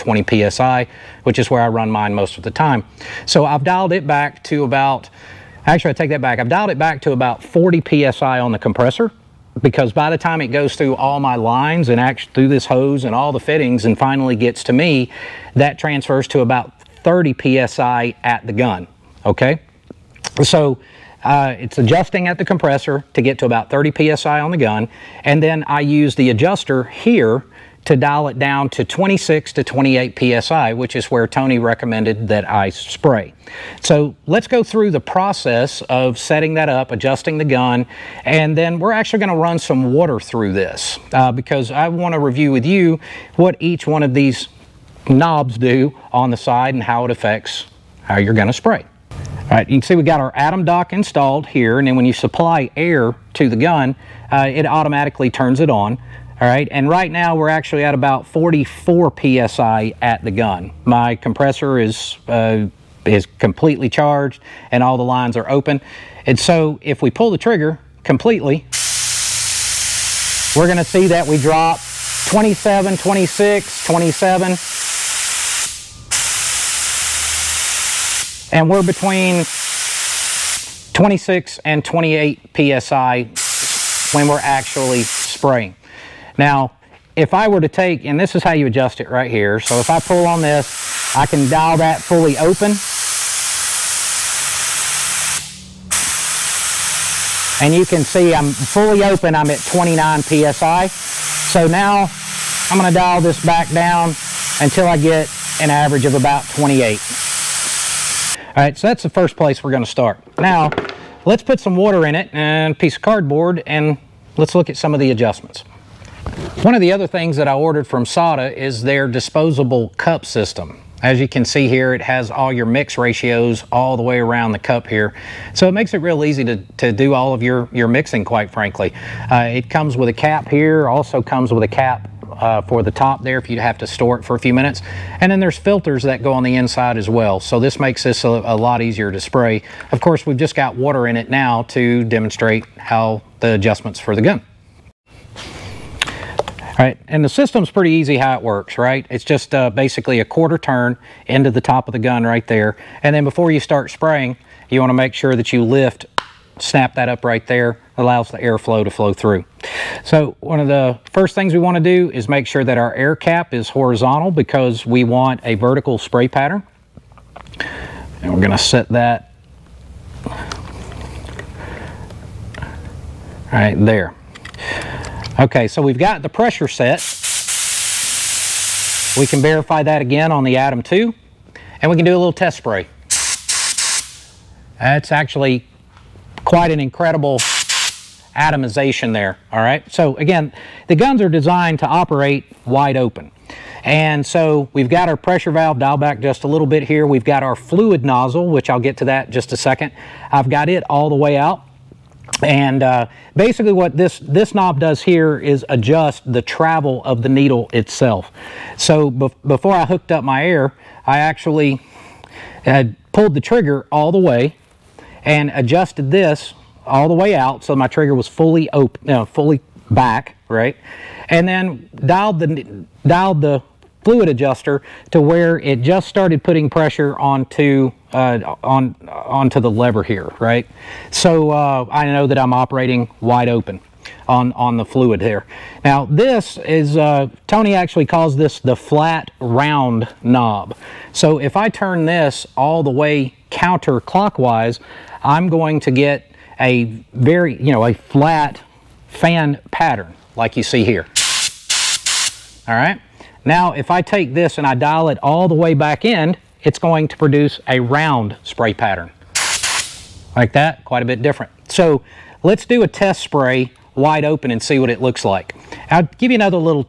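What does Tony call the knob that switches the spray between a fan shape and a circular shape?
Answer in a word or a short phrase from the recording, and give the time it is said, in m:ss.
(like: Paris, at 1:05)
flat round knob, at 3:58.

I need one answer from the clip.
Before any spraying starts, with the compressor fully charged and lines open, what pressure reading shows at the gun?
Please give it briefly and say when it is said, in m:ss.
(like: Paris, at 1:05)
44 PSI, at 0:58.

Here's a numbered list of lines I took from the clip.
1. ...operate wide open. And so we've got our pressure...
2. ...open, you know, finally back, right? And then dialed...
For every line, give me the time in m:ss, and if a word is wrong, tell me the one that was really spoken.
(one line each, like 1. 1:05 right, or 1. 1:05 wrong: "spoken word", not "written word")
1. 3:11 right
2. 3:38 wrong: "fully", not "finally".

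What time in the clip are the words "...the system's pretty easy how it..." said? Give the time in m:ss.
2:27.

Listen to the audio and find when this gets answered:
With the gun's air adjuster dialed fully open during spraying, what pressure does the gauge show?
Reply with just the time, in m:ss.
1:39.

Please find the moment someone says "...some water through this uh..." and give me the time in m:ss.
0:39.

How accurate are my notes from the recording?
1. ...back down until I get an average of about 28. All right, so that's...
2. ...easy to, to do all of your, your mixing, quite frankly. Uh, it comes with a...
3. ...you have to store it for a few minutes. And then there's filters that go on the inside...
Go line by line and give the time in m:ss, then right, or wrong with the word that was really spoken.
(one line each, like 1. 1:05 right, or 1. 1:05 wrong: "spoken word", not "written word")
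1. 1:43 right
2. 2:06 right
3. 2:13 right.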